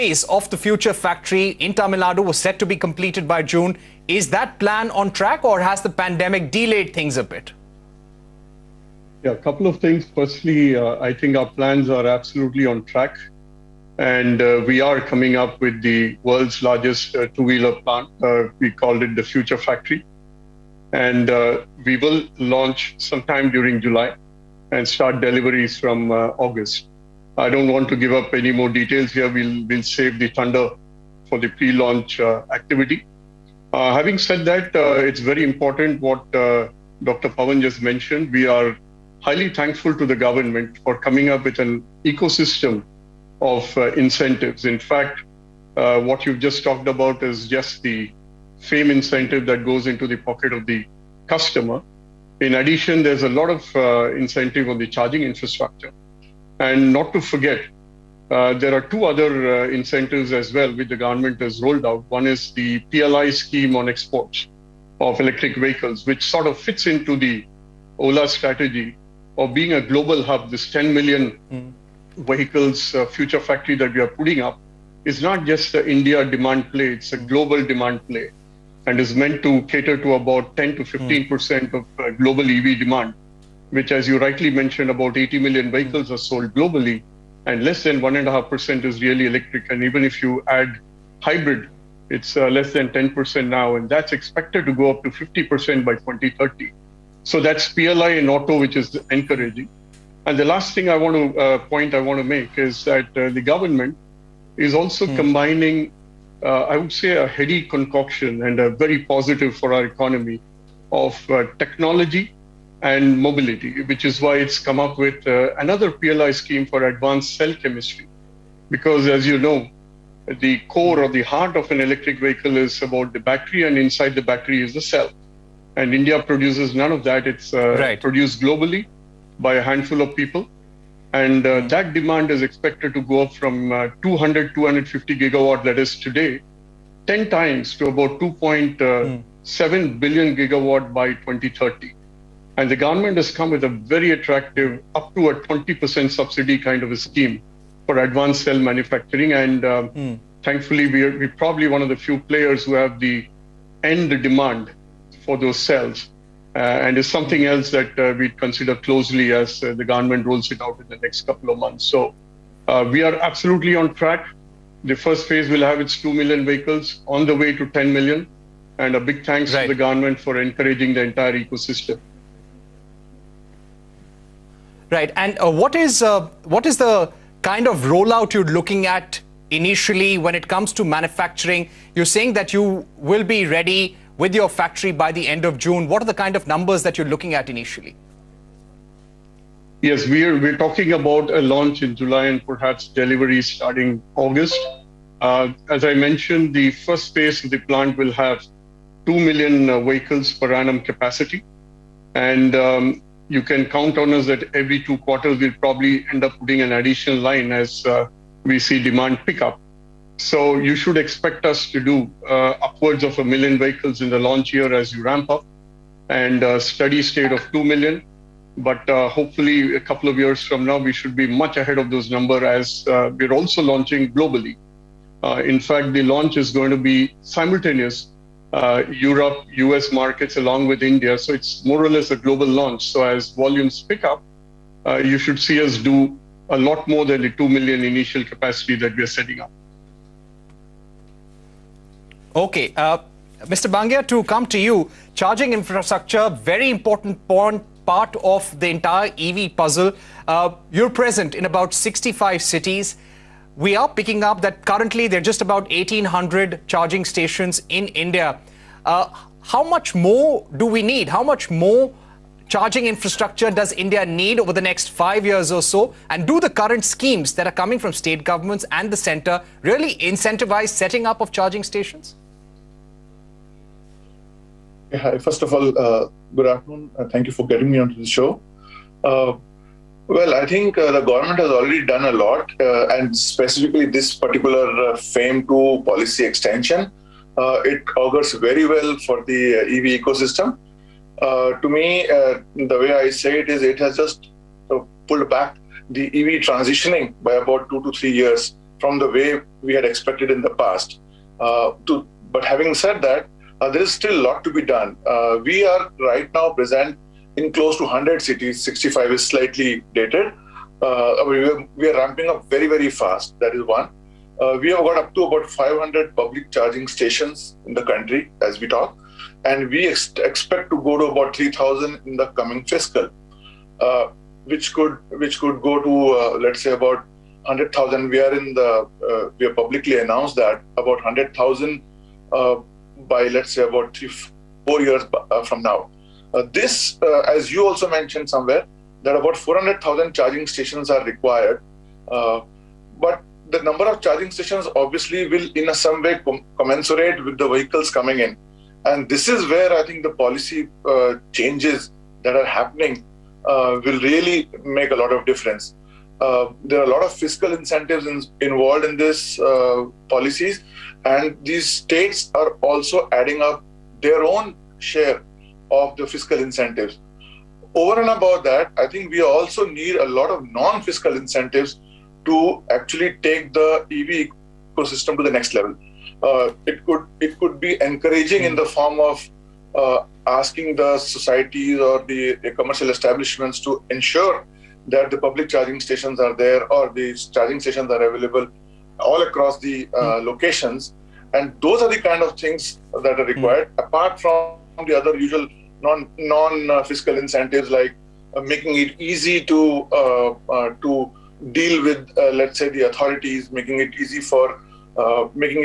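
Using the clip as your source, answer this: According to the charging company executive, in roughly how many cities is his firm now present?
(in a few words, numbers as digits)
100.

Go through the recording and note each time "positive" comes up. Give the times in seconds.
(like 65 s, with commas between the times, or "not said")
109 s.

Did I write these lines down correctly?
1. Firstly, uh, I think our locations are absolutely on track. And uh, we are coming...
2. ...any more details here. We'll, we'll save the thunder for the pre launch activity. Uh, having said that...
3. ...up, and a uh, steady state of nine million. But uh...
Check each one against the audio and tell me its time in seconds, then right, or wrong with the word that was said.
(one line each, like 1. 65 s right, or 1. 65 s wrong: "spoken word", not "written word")
1. 10 s wrong: "plans", not "locations"
2. 28 s right
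3. 215 s wrong: "two", not "nine".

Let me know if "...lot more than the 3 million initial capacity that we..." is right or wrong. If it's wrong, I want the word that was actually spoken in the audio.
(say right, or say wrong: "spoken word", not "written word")
wrong: "2", not "3".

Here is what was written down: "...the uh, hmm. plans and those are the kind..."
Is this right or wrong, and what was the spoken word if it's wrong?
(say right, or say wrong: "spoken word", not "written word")
wrong: "locations", not "plans".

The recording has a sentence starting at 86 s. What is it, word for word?
are sold globally and less than 1.5% is really electric.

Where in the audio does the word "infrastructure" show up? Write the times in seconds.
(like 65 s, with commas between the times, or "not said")
55 s, 245 s, 262 s.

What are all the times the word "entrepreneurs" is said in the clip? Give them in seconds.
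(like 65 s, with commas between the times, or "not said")
not said.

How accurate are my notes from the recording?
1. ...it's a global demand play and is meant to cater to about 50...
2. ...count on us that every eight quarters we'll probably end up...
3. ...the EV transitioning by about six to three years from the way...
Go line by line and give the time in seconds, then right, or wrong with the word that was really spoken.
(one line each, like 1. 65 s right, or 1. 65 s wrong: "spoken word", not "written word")
1. 76 s wrong: "10", not "50"
2. 203 s wrong: "two", not "eight"
3. 295 s wrong: "two", not "six".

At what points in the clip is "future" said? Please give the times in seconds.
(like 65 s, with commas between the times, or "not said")
0 s, 19 s, 73 s.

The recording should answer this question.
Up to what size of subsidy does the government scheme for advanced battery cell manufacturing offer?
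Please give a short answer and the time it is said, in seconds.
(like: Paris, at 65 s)
20%, at 145 s.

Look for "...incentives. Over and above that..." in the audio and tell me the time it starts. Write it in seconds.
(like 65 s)
366 s.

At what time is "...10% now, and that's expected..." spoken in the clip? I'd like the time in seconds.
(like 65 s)
92 s.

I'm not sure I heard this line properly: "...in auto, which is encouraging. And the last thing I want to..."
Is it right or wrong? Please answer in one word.
right.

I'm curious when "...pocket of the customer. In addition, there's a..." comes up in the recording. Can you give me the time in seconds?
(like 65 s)
50 s.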